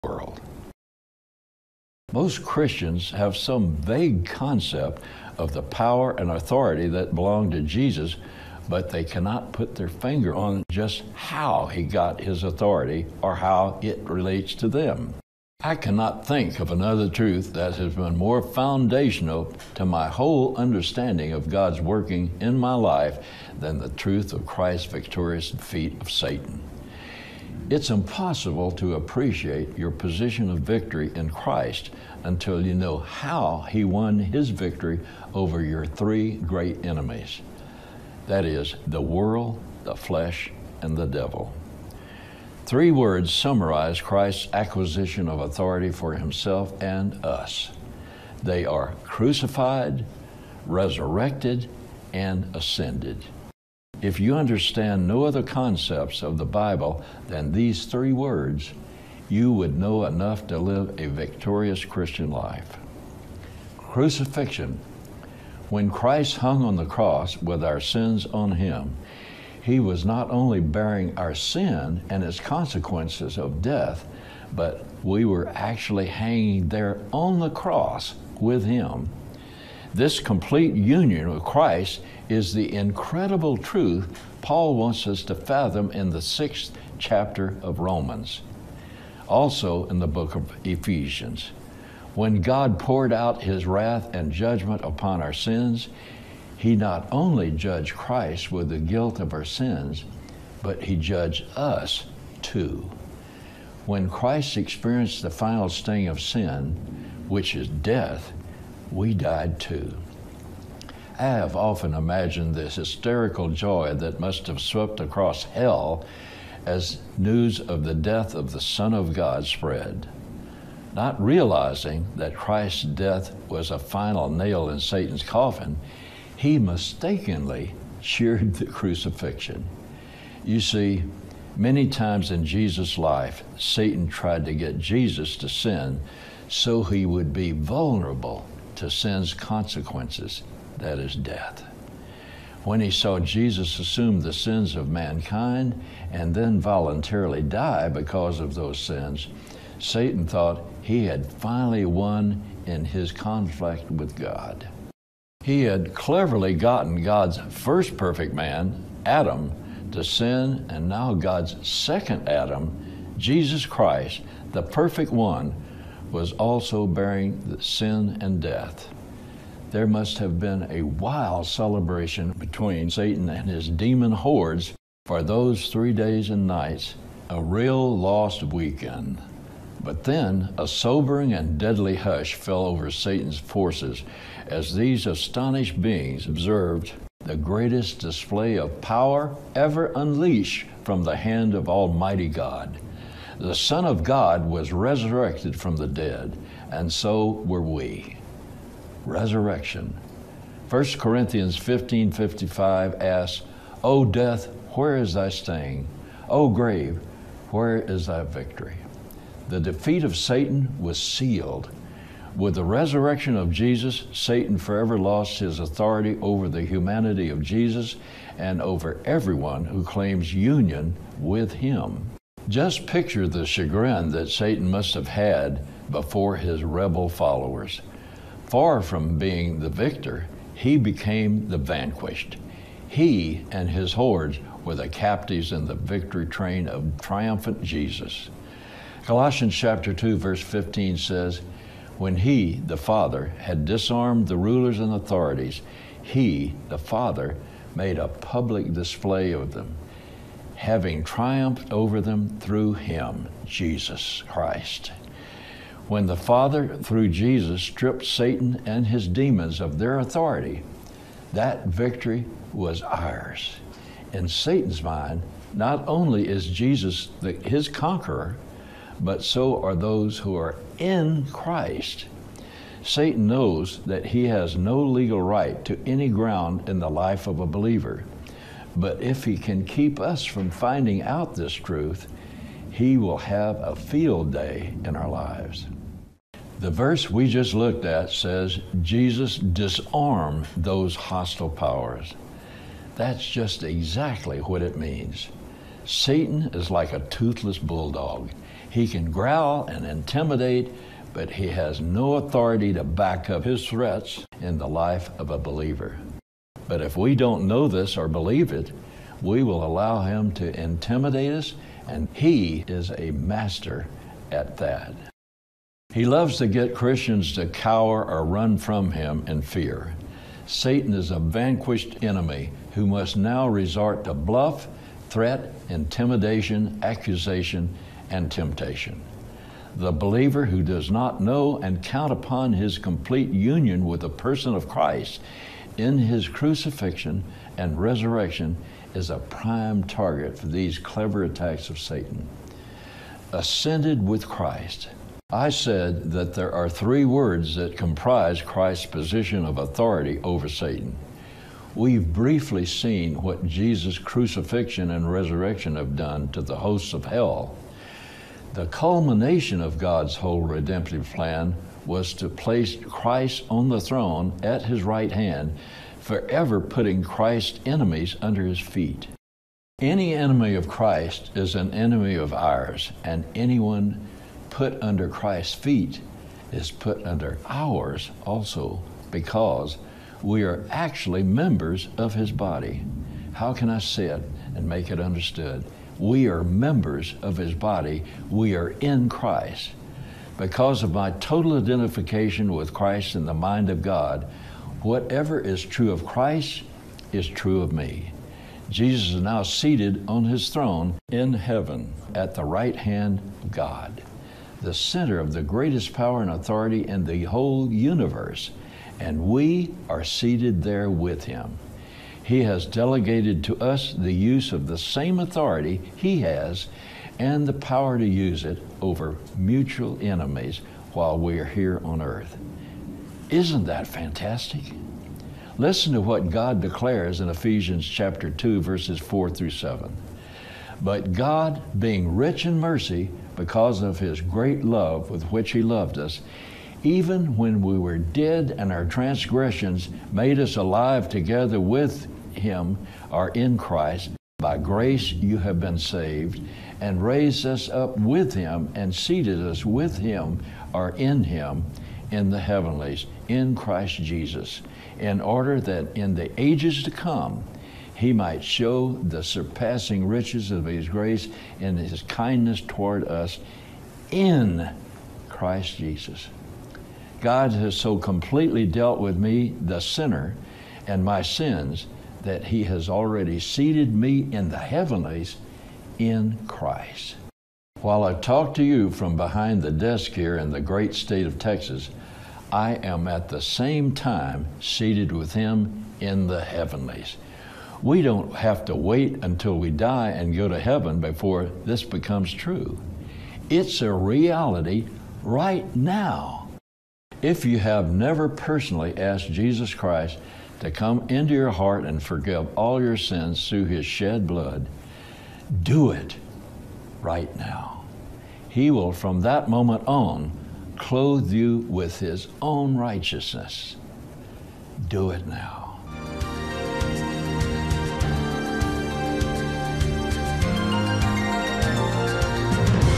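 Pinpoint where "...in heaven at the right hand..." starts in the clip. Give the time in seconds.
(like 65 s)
401 s.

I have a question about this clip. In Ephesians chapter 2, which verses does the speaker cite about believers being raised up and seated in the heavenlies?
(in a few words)
4 through 7.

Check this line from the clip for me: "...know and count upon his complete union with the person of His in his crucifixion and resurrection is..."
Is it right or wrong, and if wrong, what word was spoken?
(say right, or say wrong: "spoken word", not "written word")
wrong: "Christ", not "His".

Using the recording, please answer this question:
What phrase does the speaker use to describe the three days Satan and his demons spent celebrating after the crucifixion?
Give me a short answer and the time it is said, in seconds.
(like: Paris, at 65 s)
a real lost weekend, at 177 s.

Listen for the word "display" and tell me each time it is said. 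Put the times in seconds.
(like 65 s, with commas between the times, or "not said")
187 s, 248 s.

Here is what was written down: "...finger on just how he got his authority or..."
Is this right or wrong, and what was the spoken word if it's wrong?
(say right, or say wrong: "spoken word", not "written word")
right.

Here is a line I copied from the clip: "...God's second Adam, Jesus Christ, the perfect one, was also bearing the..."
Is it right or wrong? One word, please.
right.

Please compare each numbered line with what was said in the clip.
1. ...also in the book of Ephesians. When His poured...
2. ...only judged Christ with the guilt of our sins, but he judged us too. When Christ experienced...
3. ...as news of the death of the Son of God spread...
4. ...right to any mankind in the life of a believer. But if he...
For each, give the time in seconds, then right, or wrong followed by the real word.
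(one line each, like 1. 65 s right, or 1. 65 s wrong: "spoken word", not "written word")
1. 89 s wrong: "God", not "His"
2. 97 s right
3. 116 s right
4. 275 s wrong: "ground", not "mankind".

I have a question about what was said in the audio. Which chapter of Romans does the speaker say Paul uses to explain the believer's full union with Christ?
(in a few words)
sixth chapter.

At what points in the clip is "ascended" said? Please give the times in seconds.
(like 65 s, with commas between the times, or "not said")
52 s, 343 s.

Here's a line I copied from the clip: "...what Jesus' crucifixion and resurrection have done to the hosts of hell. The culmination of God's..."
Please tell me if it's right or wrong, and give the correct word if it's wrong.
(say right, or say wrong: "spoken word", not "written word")
right.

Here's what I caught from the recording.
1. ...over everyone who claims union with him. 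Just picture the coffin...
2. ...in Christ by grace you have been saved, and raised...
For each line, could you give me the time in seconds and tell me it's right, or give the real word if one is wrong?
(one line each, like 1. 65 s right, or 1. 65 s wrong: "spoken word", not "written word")
1. 218 s wrong: "chagrin", not "coffin"
2. 443 s right.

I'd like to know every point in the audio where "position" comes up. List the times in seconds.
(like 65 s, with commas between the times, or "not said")
29 s, 348 s.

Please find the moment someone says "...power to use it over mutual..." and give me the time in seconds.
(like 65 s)
417 s.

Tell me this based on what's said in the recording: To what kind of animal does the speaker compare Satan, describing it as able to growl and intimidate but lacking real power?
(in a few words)
toothless bulldog.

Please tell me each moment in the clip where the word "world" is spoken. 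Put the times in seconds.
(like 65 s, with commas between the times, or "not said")
0 s, 39 s.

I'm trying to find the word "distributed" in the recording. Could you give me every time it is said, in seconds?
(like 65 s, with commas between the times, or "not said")
not said.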